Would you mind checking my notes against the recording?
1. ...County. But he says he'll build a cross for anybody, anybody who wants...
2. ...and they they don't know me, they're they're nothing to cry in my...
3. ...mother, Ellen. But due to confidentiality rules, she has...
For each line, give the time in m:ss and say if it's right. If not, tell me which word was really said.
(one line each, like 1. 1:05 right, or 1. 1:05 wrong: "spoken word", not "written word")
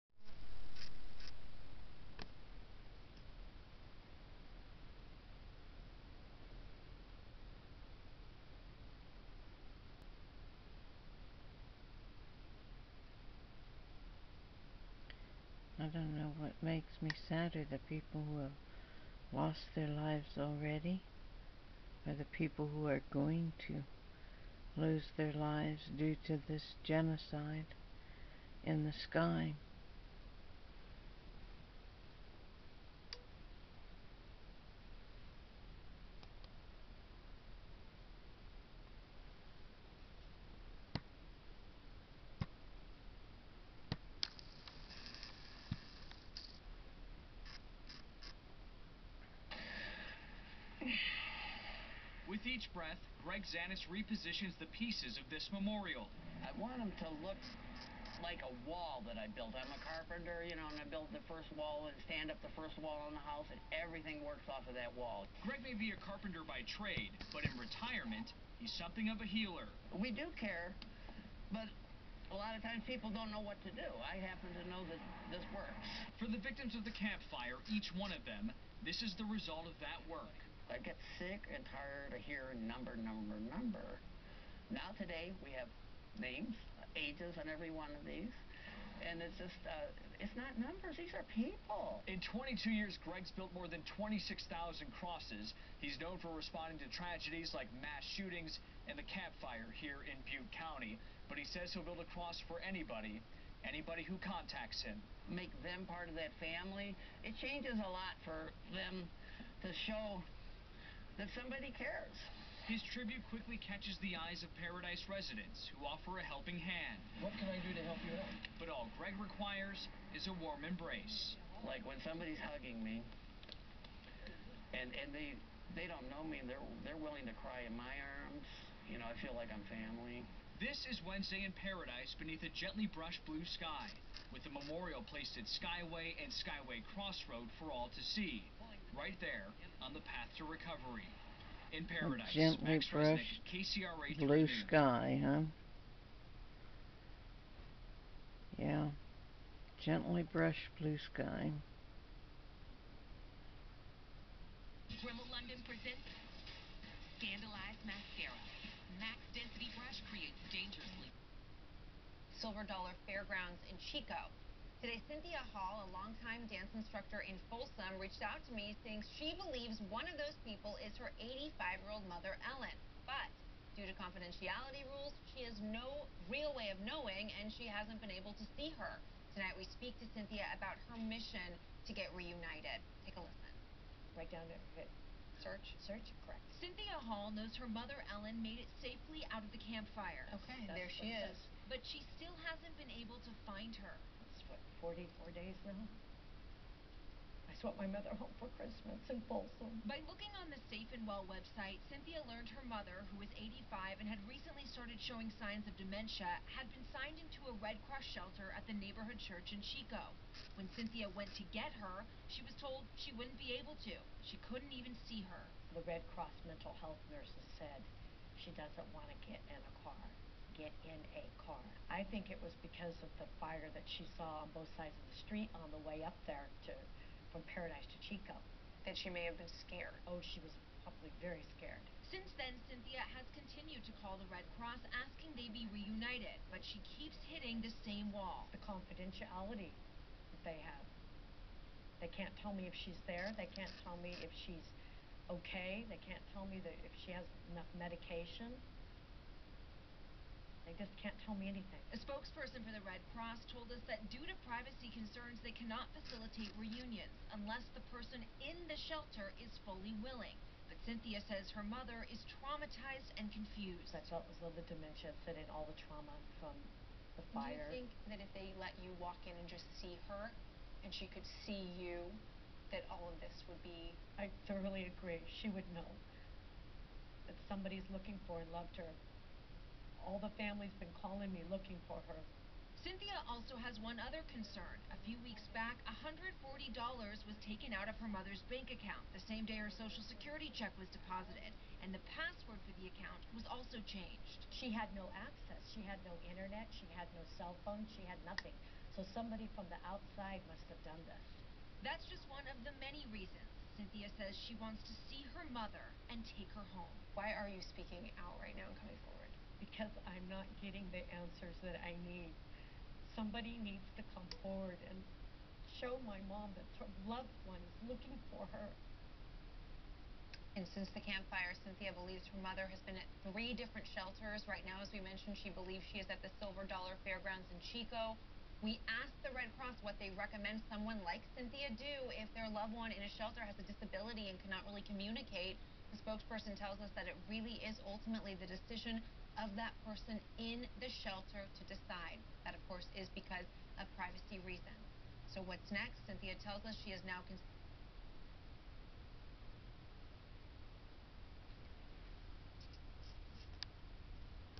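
1. 1:40 wrong: "contacts", not "wants"
2. 2:04 wrong: "willing", not "nothing"
3. 2:52 right.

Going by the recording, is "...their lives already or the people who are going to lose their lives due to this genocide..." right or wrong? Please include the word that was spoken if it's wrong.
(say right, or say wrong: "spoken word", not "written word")
right.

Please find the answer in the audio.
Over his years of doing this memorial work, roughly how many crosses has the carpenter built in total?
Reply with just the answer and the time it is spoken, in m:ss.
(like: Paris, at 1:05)
26,000, at 1:33.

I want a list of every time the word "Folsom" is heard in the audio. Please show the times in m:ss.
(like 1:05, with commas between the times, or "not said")
2:47, 3:19.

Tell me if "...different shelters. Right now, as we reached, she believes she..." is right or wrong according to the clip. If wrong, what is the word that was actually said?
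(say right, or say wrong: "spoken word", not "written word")
wrong: "mentioned", not "reached".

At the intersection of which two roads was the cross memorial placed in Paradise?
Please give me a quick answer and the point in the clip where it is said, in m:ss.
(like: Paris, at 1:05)
Skyway and Skyway Crossroad, at 2:15.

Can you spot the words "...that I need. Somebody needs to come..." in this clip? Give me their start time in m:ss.
5:11.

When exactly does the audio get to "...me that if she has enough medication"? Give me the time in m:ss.
4:06.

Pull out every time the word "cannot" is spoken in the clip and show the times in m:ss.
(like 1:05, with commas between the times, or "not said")
4:15, 5:34.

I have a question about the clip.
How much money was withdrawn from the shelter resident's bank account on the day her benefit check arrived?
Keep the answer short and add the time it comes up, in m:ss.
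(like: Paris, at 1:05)
$140, at 4:45.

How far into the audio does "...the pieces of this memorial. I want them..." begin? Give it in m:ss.
0:54.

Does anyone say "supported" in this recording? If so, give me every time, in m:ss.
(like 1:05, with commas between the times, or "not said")
not said.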